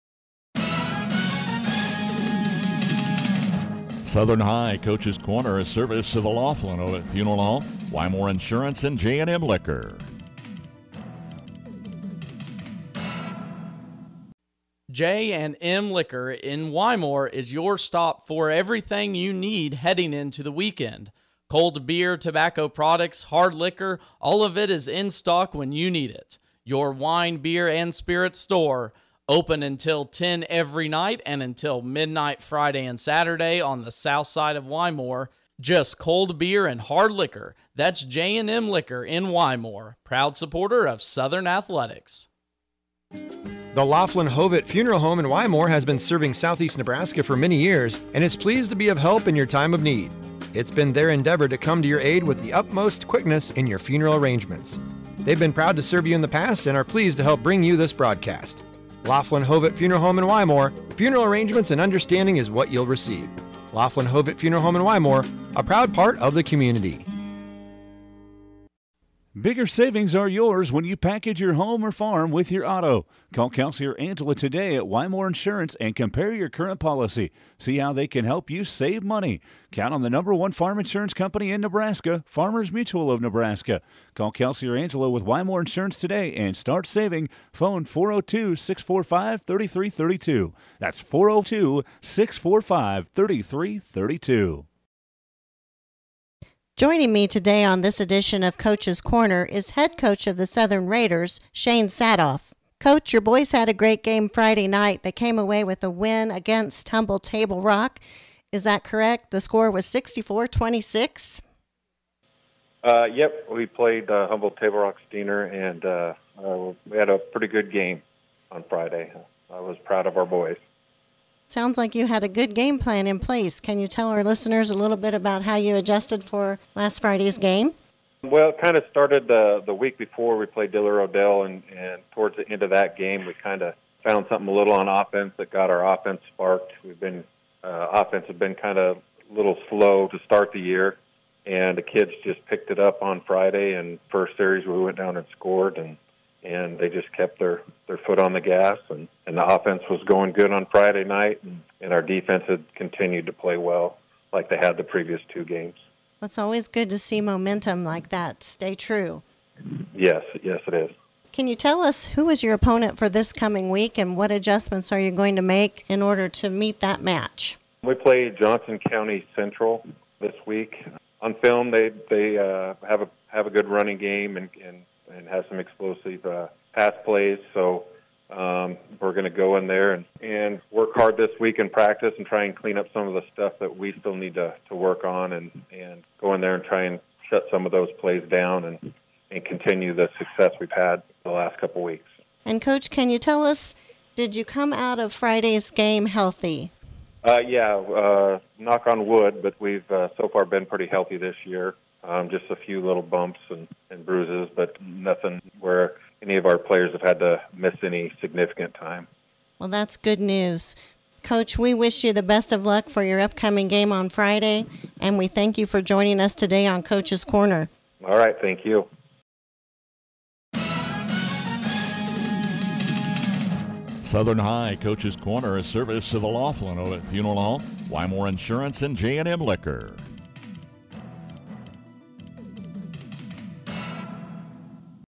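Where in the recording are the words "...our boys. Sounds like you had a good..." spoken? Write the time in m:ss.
2:00.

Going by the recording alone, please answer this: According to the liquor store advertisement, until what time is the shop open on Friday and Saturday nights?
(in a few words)
midnight.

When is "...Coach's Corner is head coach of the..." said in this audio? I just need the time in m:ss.
1:38.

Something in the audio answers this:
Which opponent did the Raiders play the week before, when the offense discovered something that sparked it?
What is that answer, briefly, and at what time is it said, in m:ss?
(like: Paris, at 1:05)
Diller Odell, at 2:10.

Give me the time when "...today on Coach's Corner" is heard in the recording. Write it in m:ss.
3:36.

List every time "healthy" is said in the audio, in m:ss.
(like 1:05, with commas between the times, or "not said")
3:16, 3:20.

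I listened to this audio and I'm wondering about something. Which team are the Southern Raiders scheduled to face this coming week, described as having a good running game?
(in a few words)
Johnson County Central.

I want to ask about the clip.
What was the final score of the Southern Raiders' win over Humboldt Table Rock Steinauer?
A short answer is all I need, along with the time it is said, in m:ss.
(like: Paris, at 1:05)
64-26, at 1:49.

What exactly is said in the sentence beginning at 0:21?
Cold beer, tobacco products, hard liquor, all of it is in stock when you need it.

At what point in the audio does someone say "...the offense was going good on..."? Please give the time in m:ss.
2:29.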